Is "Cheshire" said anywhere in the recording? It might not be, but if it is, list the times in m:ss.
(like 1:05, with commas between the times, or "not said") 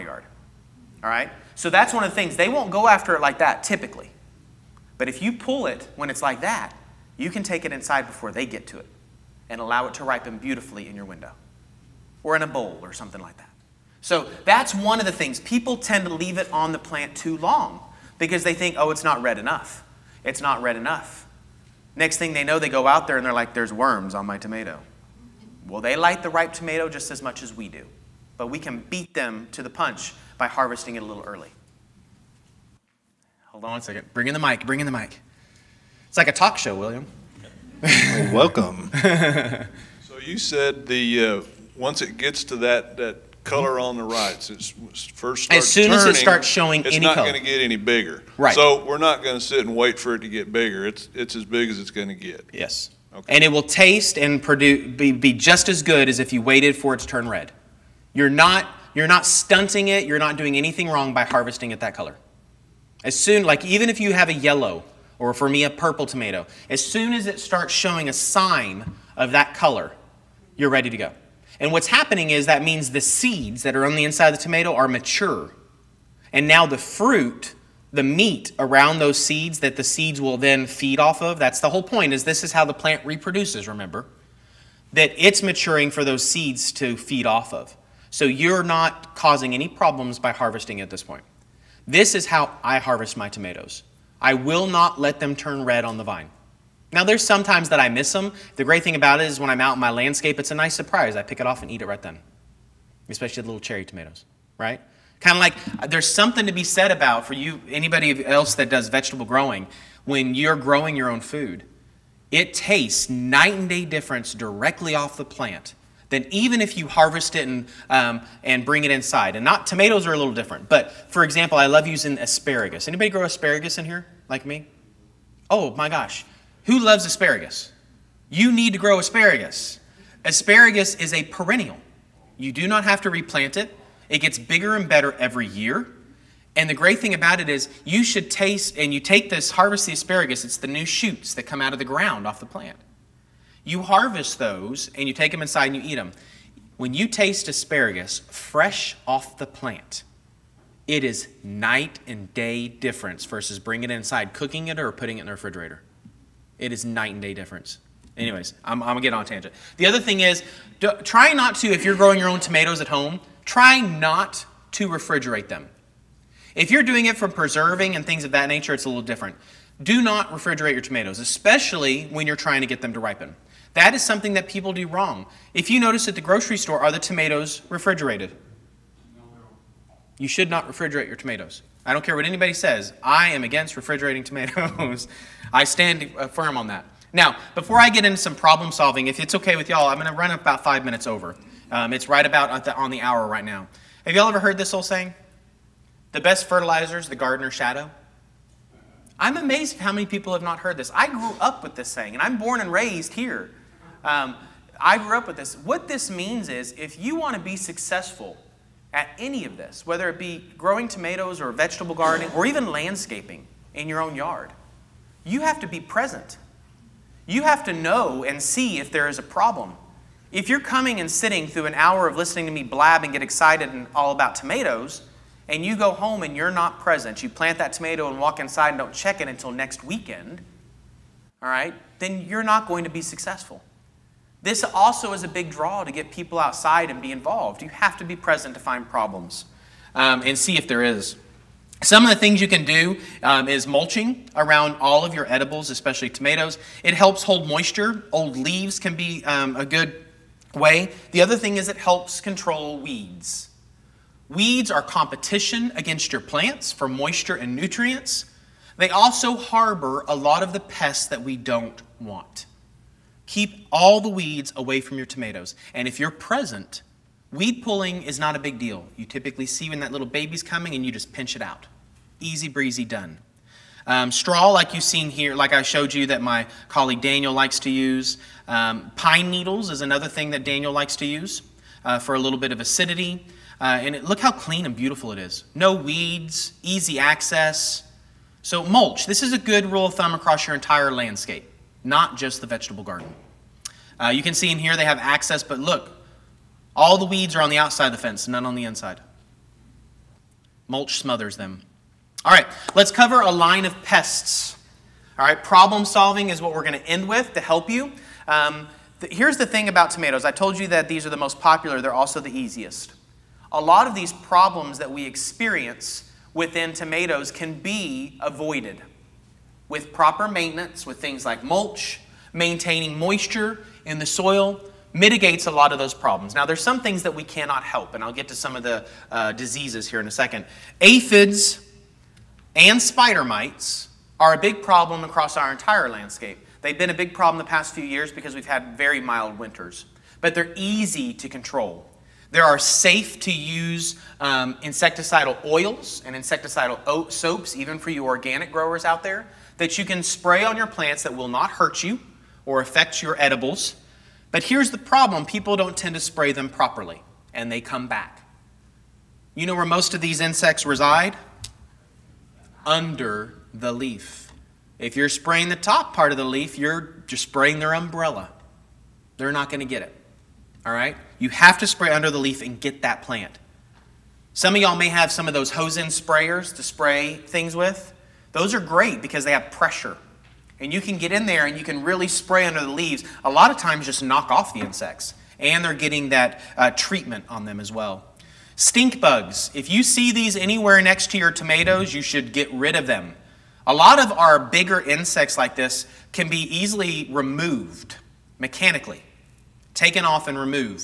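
not said.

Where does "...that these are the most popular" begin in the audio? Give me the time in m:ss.
5:10.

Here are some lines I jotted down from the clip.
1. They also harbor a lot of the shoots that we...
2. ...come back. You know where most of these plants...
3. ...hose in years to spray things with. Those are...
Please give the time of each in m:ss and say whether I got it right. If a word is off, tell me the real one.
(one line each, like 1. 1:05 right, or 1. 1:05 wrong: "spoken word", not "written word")
1. 4:18 wrong: "pests", not "shoots"
2. 5:57 wrong: "insects", not "plants"
3. 6:15 wrong: "sprayers", not "years".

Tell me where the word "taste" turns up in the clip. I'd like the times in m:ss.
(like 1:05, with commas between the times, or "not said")
0:53, 1:52, 2:18, 2:27.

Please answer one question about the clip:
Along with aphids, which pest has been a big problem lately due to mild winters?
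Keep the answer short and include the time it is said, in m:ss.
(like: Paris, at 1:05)
spider mites, at 5:32.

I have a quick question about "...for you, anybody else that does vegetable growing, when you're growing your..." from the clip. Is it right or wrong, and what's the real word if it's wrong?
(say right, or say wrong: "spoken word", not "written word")
right.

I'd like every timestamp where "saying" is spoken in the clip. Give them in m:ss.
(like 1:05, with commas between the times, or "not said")
3:14, 3:21.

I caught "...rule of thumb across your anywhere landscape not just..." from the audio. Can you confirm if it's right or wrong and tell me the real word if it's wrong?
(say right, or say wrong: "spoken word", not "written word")
wrong: "entire", not "anywhere".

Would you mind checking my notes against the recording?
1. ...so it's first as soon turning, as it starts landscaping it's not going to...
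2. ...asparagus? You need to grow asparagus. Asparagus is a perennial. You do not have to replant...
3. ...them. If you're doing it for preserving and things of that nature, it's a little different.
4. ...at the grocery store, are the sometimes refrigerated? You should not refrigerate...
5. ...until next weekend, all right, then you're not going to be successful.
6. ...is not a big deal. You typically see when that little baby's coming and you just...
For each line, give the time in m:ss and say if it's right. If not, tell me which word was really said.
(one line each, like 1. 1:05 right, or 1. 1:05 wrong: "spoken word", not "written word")
1. 0:44 wrong: "showing", not "landscaping"
2. 2:07 right
3. 2:45 right
4. 2:56 wrong: "tomatoes", not "sometimes"
5. 3:49 right
6. 4:28 right.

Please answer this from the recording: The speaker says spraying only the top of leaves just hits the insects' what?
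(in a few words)
umbrella.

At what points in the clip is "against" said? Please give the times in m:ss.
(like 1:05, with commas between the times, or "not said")
3:03, 4:15.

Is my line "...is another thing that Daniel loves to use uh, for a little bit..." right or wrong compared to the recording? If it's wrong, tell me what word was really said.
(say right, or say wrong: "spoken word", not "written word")
wrong: "likes", not "loves".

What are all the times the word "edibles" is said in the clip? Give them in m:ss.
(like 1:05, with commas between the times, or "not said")
4:05, 5:53.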